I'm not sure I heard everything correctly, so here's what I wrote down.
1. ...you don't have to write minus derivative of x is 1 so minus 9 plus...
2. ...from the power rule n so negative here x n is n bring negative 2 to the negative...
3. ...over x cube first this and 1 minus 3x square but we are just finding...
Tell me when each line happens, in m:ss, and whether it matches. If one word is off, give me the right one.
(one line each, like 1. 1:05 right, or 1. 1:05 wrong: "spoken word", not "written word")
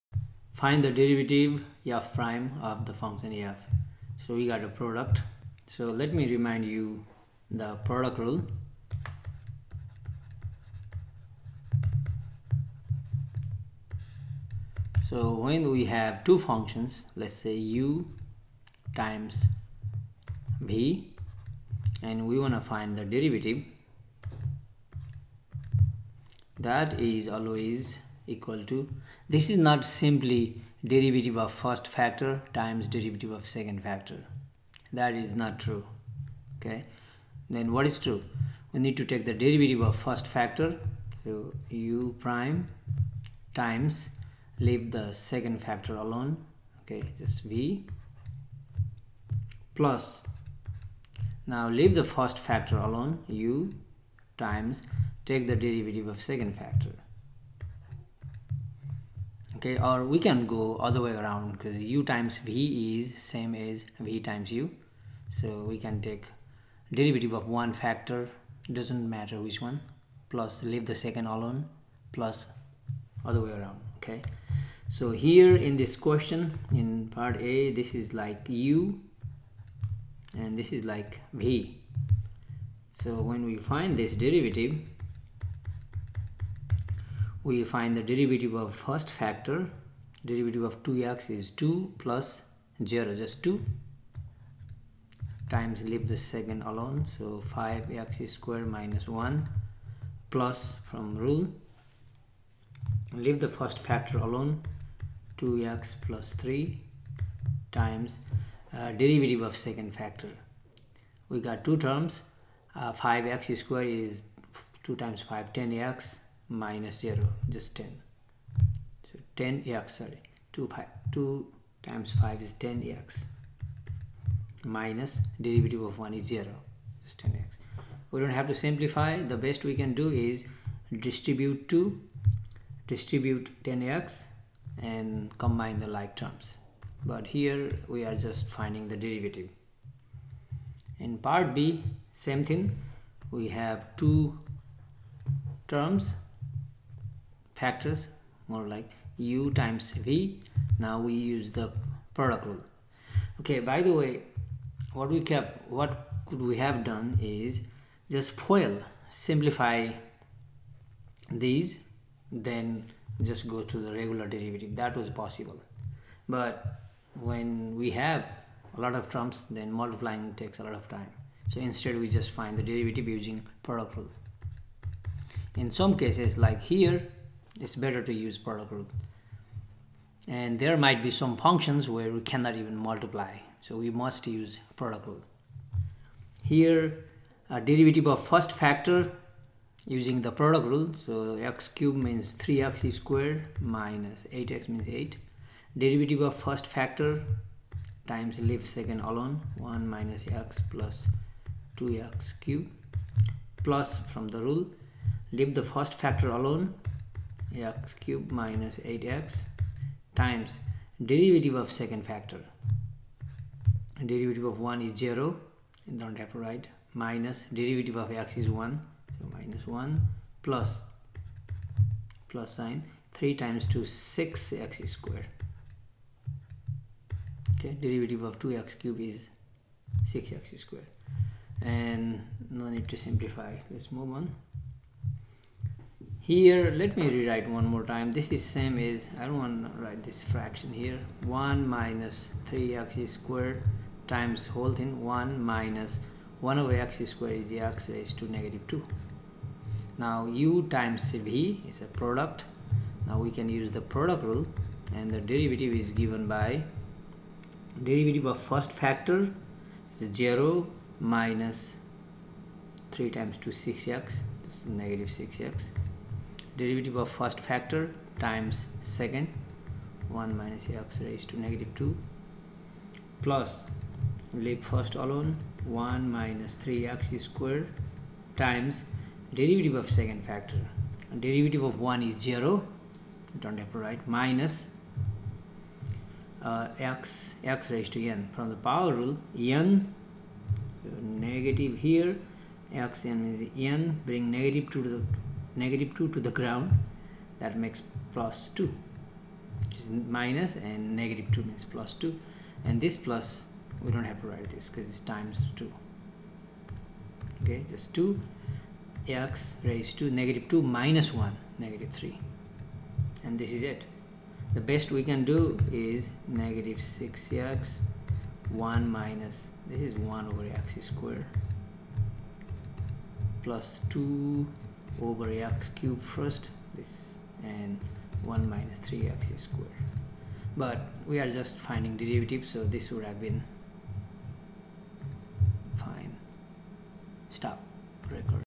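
1. 3:35 wrong: "1", not "9"
2. 4:48 right
3. 5:24 right.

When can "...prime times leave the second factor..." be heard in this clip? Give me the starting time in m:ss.
0:42.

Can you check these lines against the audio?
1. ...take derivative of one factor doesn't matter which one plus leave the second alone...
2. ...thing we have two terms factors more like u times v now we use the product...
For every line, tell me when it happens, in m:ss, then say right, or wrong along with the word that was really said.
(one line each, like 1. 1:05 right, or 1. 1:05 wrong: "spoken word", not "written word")
1. 1:06 right
2. 2:22 right.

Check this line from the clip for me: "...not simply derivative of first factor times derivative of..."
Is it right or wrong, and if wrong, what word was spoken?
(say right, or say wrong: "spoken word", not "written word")
right.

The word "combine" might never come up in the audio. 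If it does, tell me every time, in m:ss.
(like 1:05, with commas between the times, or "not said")
2:15.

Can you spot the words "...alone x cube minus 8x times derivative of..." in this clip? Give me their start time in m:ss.
3:26.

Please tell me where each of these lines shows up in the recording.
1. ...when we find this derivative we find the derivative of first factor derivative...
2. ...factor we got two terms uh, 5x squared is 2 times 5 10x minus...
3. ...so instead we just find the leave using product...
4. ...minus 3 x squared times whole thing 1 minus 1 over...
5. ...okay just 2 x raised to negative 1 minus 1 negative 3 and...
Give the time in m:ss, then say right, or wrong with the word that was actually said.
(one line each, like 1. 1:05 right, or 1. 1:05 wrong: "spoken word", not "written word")
1. 1:23 right
2. 1:49 right
3. 2:51 wrong: "derivative", not "leave"
4. 4:01 right
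5. 5:07 wrong: "2", not "1".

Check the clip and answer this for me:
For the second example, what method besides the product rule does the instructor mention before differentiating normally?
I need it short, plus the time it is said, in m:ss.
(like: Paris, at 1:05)
FOIL, at 2:38.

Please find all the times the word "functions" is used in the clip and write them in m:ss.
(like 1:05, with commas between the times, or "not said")
0:02, 0:16, 3:01.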